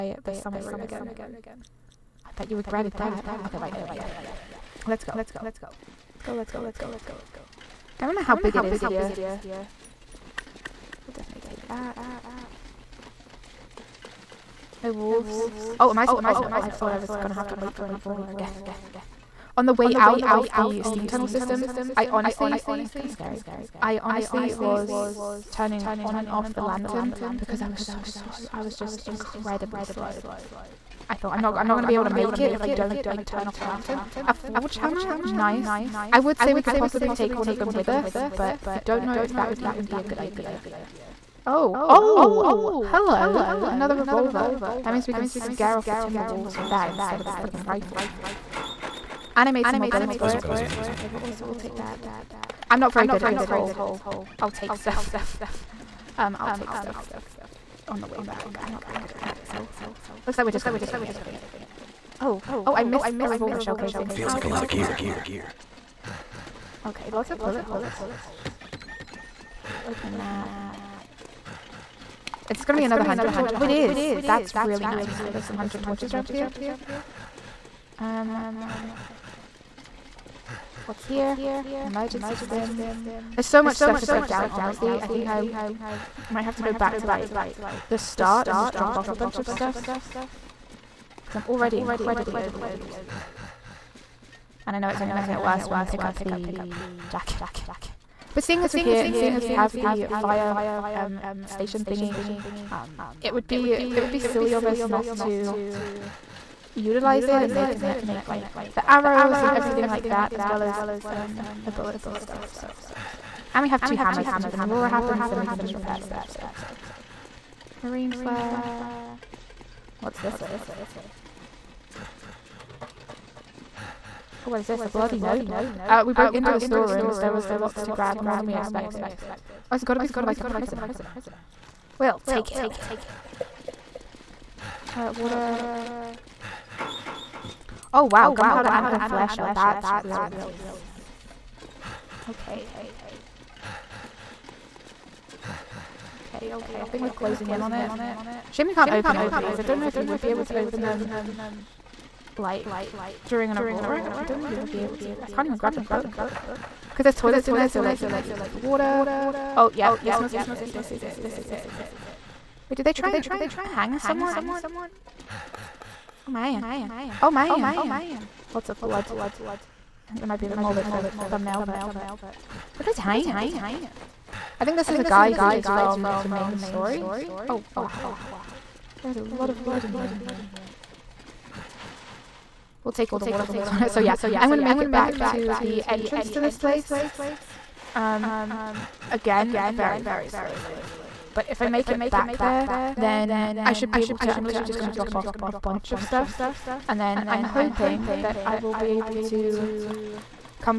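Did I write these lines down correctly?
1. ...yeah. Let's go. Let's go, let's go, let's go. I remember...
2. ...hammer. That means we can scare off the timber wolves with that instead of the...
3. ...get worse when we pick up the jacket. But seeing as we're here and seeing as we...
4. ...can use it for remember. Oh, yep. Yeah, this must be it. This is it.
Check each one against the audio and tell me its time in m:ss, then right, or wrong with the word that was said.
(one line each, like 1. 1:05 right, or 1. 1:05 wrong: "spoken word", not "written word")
1. 0:03 right
2. 0:43 wrong: "revolver", not "hammer"
3. 1:35 right
4. 2:38 wrong: "water", not "remember".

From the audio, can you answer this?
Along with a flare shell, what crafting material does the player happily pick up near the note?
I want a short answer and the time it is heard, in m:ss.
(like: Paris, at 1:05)
Gunpowder, at 2:18.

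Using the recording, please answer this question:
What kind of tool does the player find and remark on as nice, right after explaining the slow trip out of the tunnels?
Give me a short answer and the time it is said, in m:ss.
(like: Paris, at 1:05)
Forge hammer, at 0:34.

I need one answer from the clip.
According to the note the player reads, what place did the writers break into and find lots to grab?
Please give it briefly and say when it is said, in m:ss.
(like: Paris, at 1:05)
The storerooms, at 2:06.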